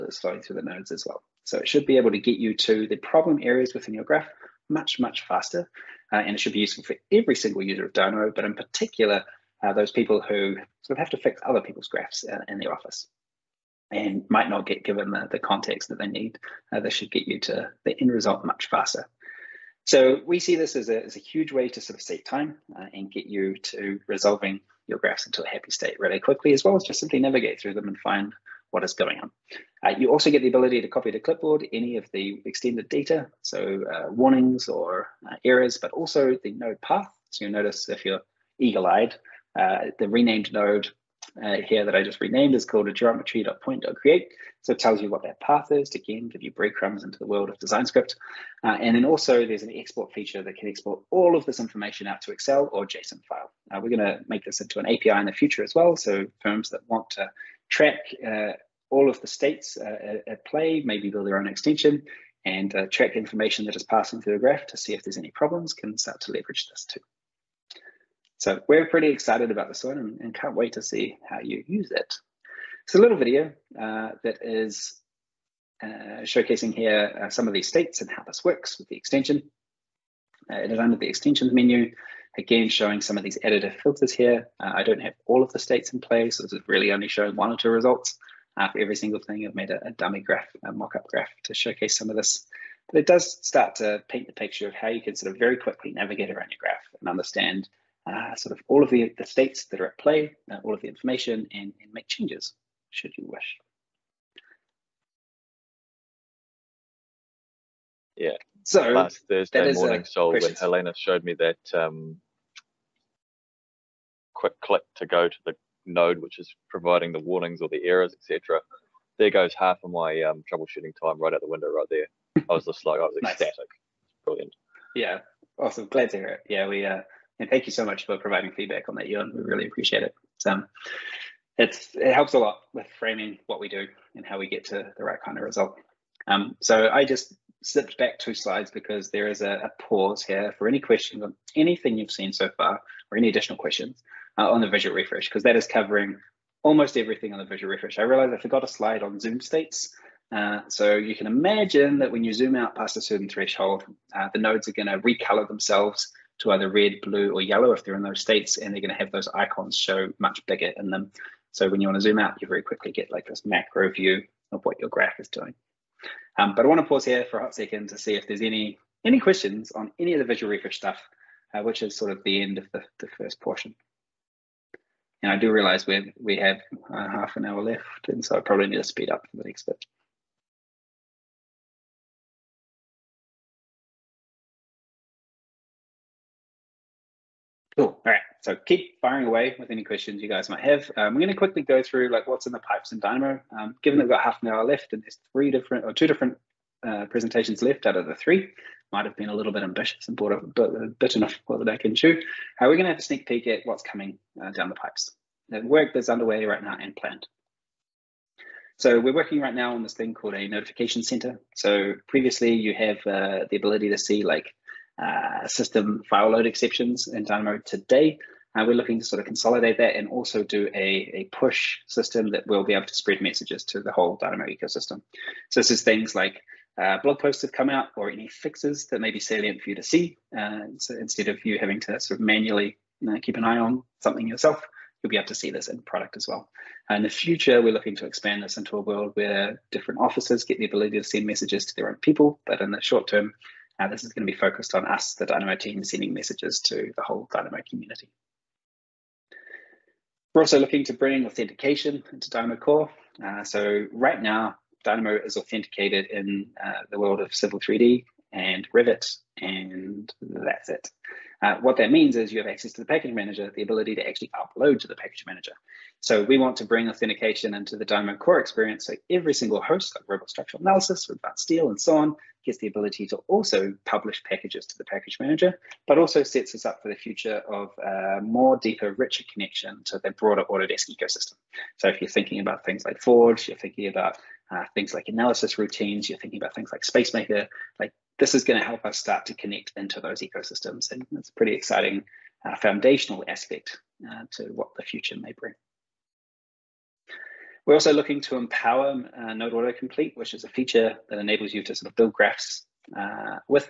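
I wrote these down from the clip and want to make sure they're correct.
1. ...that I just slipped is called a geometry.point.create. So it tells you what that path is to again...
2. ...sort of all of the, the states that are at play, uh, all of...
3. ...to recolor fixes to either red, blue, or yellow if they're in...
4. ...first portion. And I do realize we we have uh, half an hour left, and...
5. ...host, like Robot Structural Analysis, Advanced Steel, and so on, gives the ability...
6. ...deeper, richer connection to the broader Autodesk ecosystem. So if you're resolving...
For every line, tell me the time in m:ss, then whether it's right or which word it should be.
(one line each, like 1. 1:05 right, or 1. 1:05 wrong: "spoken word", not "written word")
1. 0:41 wrong: "renamed", not "slipped"
2. 1:38 right
3. 2:34 wrong: "themselves", not "fixes"
4. 2:53 right
5. 4:29 right
6. 4:38 wrong: "thinking", not "resolving".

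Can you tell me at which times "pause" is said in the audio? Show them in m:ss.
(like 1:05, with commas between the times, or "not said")
2:19, 2:46.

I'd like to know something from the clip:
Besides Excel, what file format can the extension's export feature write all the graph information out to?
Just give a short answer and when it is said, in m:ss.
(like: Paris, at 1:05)
JSON, at 0:52.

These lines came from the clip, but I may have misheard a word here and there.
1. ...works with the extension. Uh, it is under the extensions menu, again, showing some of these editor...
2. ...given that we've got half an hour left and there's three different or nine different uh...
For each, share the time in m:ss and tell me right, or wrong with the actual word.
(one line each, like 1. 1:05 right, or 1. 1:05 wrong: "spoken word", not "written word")
1. 1:18 right
2. 3:13 wrong: "two", not "nine".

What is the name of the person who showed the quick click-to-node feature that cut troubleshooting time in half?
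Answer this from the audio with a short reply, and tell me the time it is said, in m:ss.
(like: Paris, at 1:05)
Helena, at 1:50.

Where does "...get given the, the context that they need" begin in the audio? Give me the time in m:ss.
0:14.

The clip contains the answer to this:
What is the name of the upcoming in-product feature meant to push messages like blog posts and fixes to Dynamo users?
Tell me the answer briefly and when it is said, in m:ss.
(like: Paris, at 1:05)
Notification center, at 3:30.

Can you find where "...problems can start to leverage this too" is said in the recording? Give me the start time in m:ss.
1:05.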